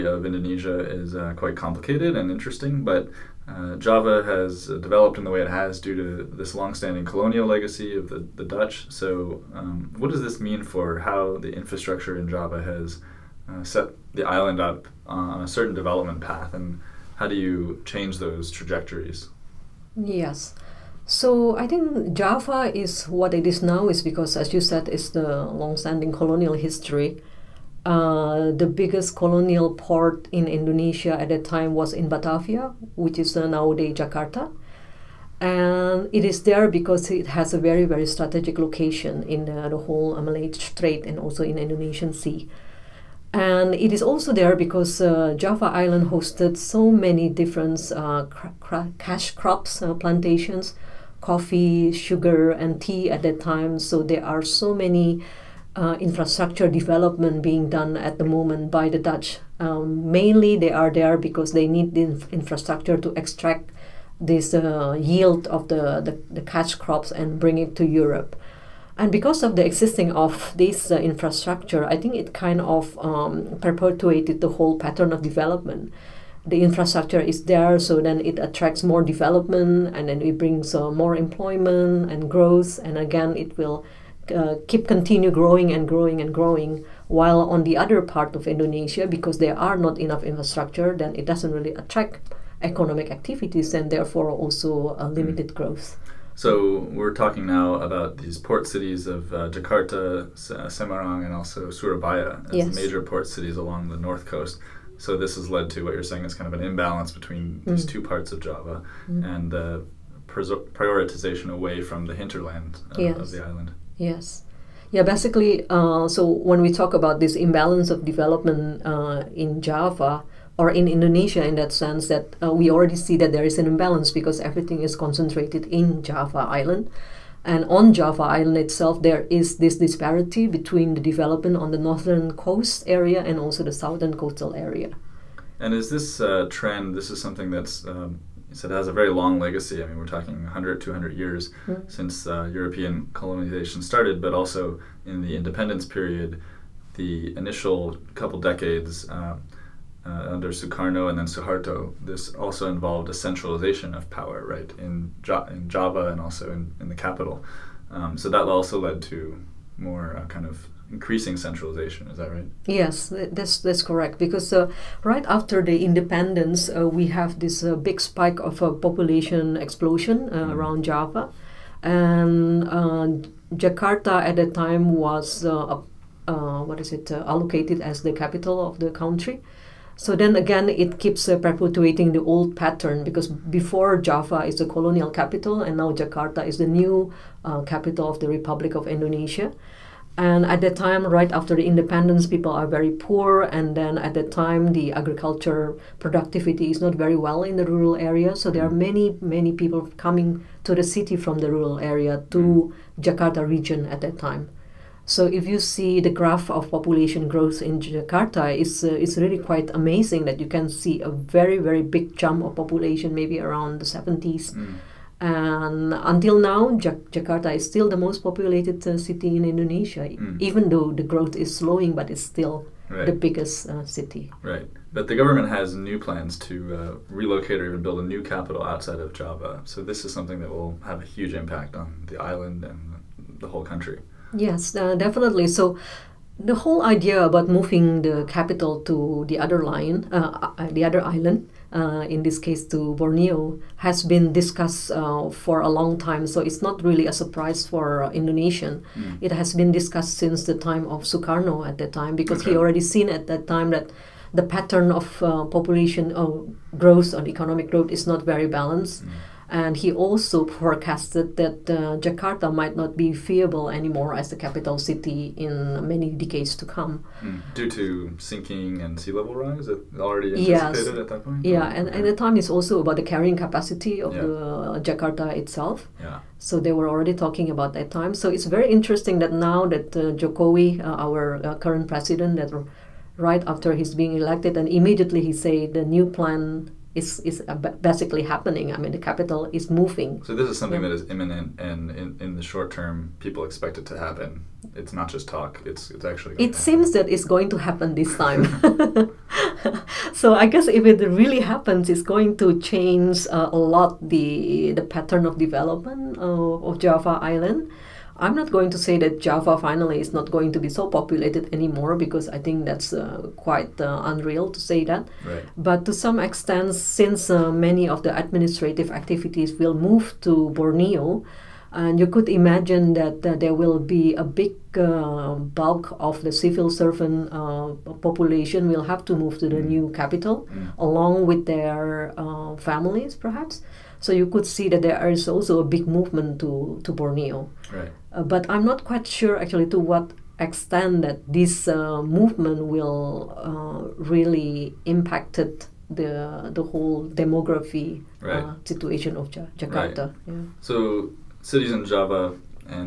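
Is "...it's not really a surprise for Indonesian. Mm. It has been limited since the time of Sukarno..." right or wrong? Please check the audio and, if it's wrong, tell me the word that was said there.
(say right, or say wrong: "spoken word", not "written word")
wrong: "discussed", not "limited".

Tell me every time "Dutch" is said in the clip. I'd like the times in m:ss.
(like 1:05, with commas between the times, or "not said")
0:08, 0:58.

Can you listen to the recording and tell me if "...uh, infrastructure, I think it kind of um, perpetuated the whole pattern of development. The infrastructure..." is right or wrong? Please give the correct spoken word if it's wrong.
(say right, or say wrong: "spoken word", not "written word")
right.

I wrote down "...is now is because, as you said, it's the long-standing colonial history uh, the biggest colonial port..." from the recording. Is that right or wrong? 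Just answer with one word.
right.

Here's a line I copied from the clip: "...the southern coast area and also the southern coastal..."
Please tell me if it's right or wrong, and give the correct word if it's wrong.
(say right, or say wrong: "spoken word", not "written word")
wrong: "northern", not "southern".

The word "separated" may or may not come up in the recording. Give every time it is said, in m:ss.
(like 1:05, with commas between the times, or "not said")
not said.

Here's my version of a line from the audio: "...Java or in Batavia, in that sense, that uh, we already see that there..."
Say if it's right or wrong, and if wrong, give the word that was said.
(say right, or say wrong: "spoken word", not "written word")
wrong: "Indonesia", not "Batavia".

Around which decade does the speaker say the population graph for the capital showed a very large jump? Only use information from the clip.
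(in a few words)
the 70s.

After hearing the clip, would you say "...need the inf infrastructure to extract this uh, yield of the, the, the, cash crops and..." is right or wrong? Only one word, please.
right.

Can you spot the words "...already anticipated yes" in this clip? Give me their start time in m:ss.
4:29.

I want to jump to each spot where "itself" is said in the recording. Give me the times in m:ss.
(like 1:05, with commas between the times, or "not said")
2:08, 4:35.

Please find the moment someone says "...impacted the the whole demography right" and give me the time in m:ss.
5:44.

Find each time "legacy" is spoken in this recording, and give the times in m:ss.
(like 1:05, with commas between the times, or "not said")
0:07, 2:19.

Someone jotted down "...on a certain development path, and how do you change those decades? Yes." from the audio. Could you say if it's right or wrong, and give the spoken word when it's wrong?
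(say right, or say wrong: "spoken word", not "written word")
wrong: "trajectories", not "decades".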